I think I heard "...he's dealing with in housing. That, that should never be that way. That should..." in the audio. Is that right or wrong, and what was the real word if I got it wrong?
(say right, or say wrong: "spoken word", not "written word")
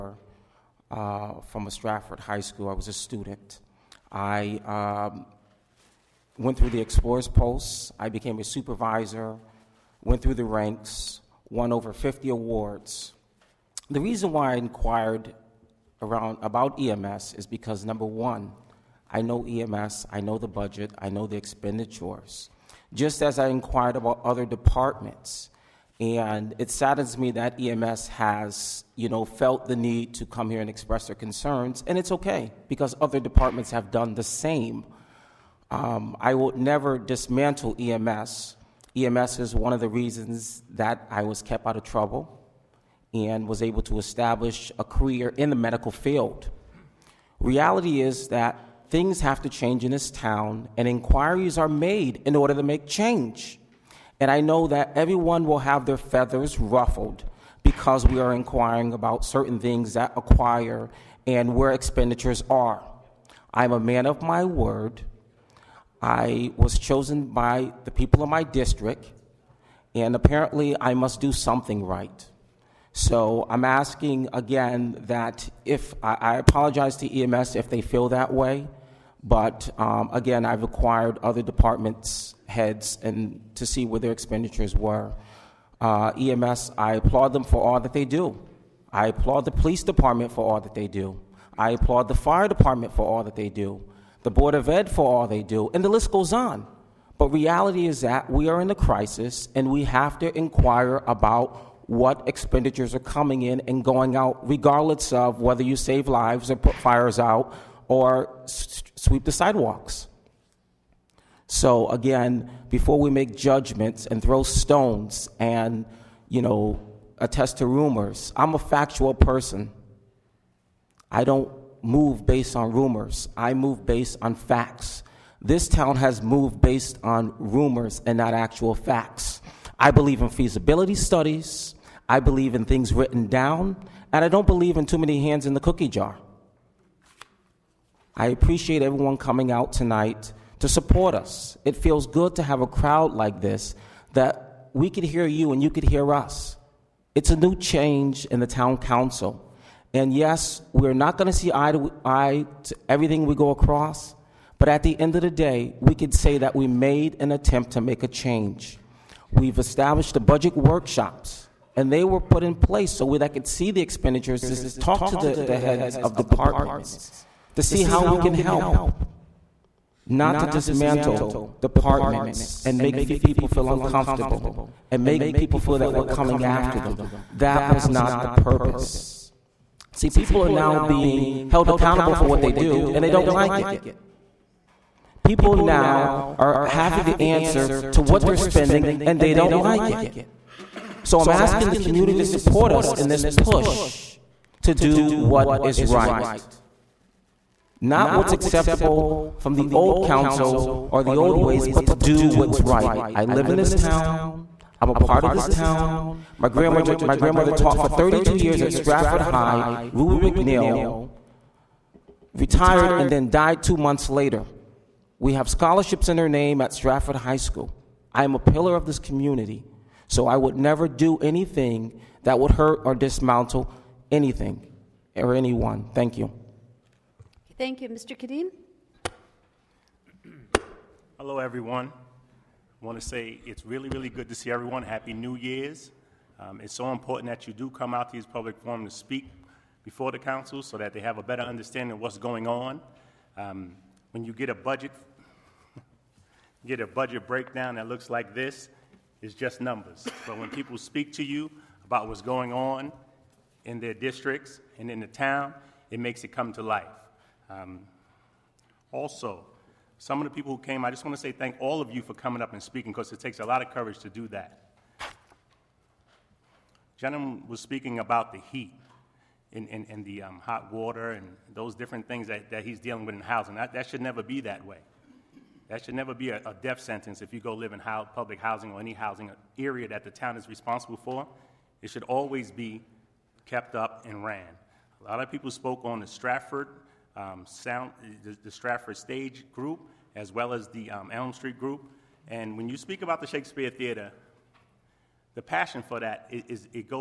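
right.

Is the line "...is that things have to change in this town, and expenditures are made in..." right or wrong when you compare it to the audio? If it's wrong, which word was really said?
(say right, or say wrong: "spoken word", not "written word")
wrong: "inquiries", not "expenditures".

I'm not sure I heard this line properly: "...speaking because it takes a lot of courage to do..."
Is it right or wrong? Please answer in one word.
right.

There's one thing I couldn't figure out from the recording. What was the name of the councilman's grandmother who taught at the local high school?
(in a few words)
Ruby McNeil.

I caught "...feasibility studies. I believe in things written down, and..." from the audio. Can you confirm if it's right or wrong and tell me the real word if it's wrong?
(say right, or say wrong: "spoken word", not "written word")
right.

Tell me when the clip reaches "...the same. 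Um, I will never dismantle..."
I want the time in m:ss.
0:34.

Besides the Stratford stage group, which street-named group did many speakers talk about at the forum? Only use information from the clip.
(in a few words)
Elm Street Group.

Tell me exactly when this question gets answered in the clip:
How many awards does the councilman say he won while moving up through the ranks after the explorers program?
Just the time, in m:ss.
0:11.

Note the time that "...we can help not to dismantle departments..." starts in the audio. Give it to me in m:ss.
2:48.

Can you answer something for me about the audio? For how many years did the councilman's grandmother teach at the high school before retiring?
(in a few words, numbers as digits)
32.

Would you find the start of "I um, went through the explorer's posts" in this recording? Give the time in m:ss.
0:04.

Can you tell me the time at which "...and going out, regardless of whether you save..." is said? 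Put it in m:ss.
1:43.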